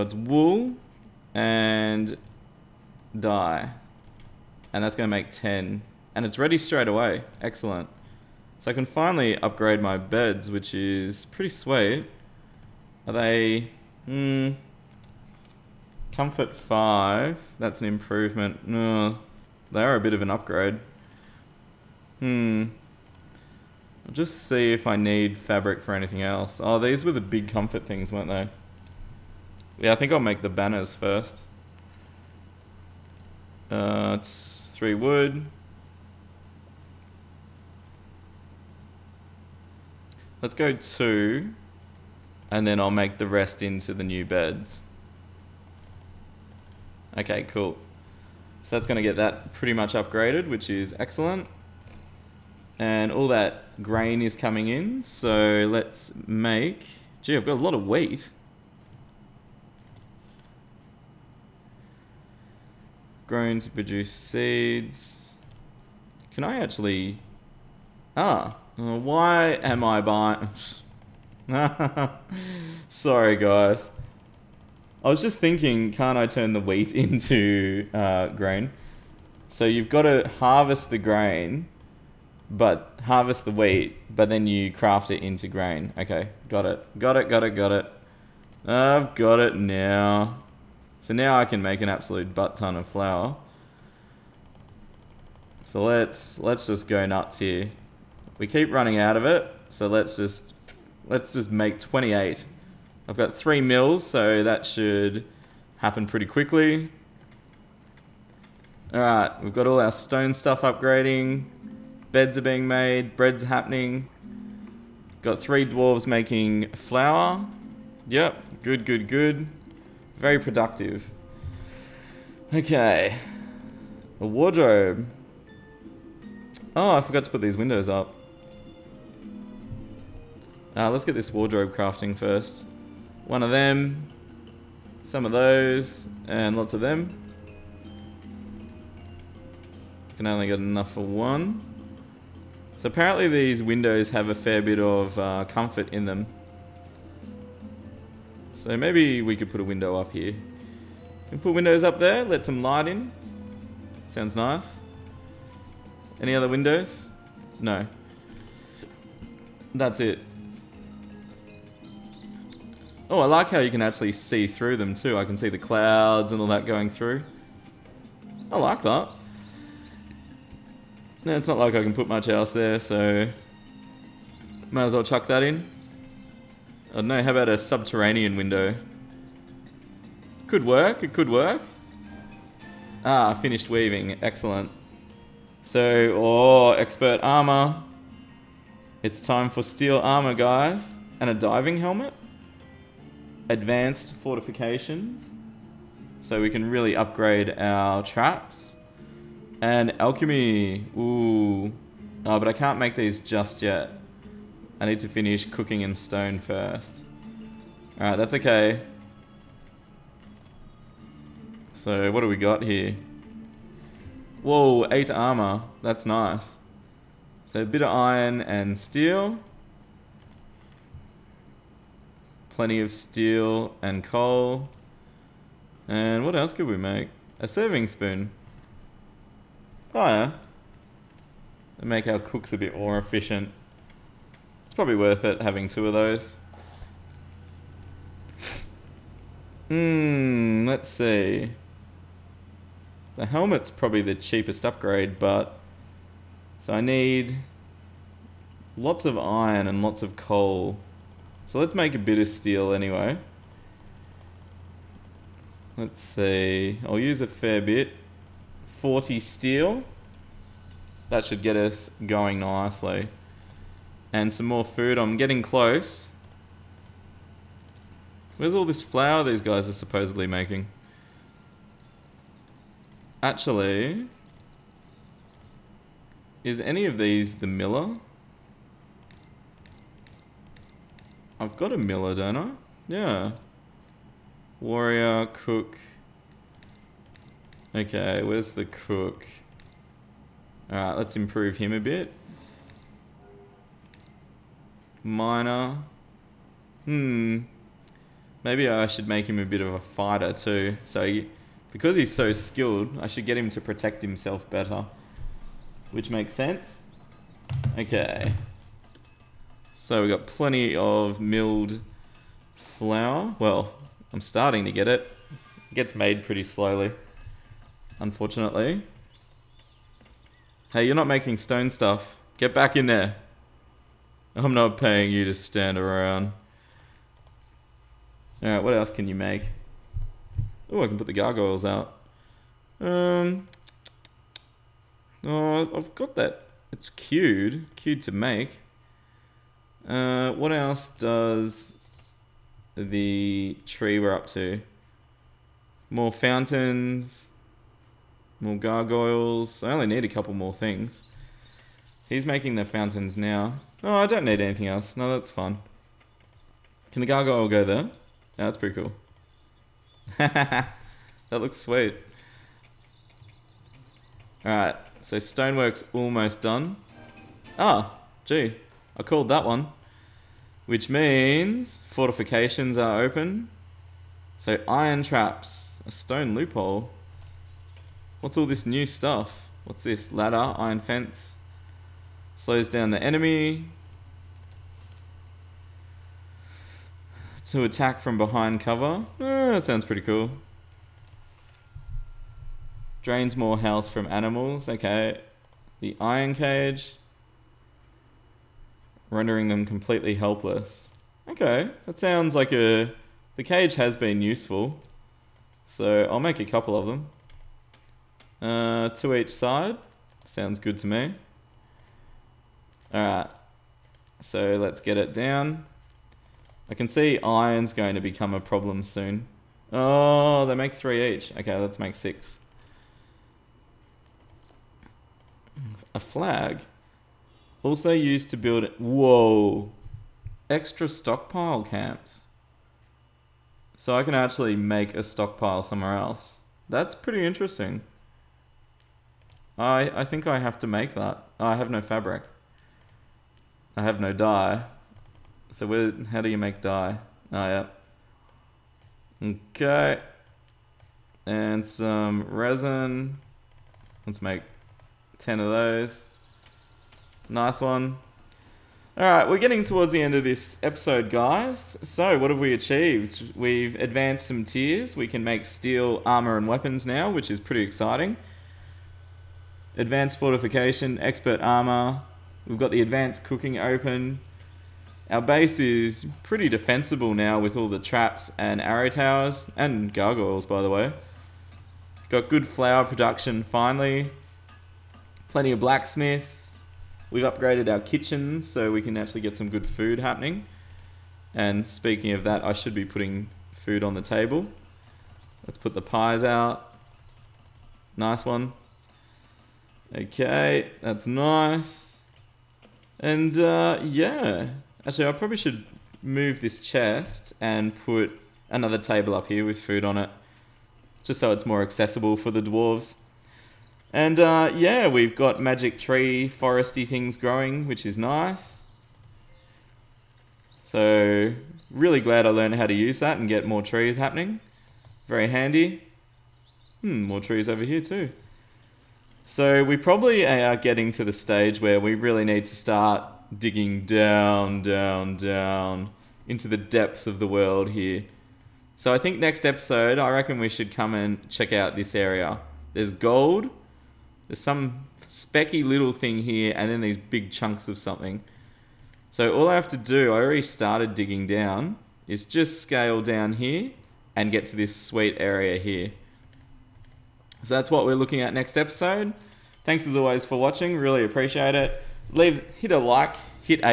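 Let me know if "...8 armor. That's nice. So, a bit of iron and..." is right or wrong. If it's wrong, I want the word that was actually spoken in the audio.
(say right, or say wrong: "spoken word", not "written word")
right.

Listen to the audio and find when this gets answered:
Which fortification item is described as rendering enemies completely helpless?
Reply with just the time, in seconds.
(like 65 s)
395 s.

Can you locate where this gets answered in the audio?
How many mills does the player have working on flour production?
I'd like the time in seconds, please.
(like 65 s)
103 s.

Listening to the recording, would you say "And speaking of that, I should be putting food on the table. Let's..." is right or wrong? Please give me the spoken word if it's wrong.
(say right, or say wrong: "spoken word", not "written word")
right.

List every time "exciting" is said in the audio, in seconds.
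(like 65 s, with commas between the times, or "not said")
467 s.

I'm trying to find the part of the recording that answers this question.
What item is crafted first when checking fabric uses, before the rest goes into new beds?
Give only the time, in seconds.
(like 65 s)
30 s.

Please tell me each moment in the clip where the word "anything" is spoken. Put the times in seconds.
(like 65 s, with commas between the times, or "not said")
25 s, 354 s.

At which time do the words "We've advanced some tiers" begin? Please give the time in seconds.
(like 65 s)
463 s.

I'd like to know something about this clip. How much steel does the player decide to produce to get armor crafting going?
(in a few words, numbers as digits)
40.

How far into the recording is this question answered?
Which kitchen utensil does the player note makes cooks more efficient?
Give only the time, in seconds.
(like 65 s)
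227 s.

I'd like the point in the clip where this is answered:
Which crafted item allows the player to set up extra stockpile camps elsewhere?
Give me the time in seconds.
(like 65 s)
425 s.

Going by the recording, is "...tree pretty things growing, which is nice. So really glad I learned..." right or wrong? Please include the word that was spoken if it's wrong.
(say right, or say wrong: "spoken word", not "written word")
wrong: "foresty", not "pretty".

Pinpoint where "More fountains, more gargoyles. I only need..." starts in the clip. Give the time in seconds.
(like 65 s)
345 s.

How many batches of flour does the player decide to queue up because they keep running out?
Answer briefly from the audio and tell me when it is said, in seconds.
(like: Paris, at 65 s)
28, at 101 s.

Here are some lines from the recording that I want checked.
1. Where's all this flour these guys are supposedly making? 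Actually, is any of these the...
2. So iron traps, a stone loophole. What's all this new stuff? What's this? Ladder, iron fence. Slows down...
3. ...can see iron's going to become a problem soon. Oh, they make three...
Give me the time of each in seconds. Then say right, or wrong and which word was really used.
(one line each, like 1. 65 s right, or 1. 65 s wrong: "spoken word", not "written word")
1. 268 s right
2. 374 s right
3. 416 s right.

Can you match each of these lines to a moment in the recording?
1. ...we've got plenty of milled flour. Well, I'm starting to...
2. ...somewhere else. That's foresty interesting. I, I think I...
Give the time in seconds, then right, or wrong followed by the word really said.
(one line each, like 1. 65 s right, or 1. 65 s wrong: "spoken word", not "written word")
1. 310 s right
2. 435 s wrong: "pretty", not "foresty".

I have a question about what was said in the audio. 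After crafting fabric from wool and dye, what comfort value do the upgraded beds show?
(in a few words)
5.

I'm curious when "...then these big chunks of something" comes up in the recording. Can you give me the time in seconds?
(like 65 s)
546 s.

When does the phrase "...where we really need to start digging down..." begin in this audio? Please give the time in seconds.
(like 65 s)
531 s.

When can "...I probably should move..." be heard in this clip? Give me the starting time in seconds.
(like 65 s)
505 s.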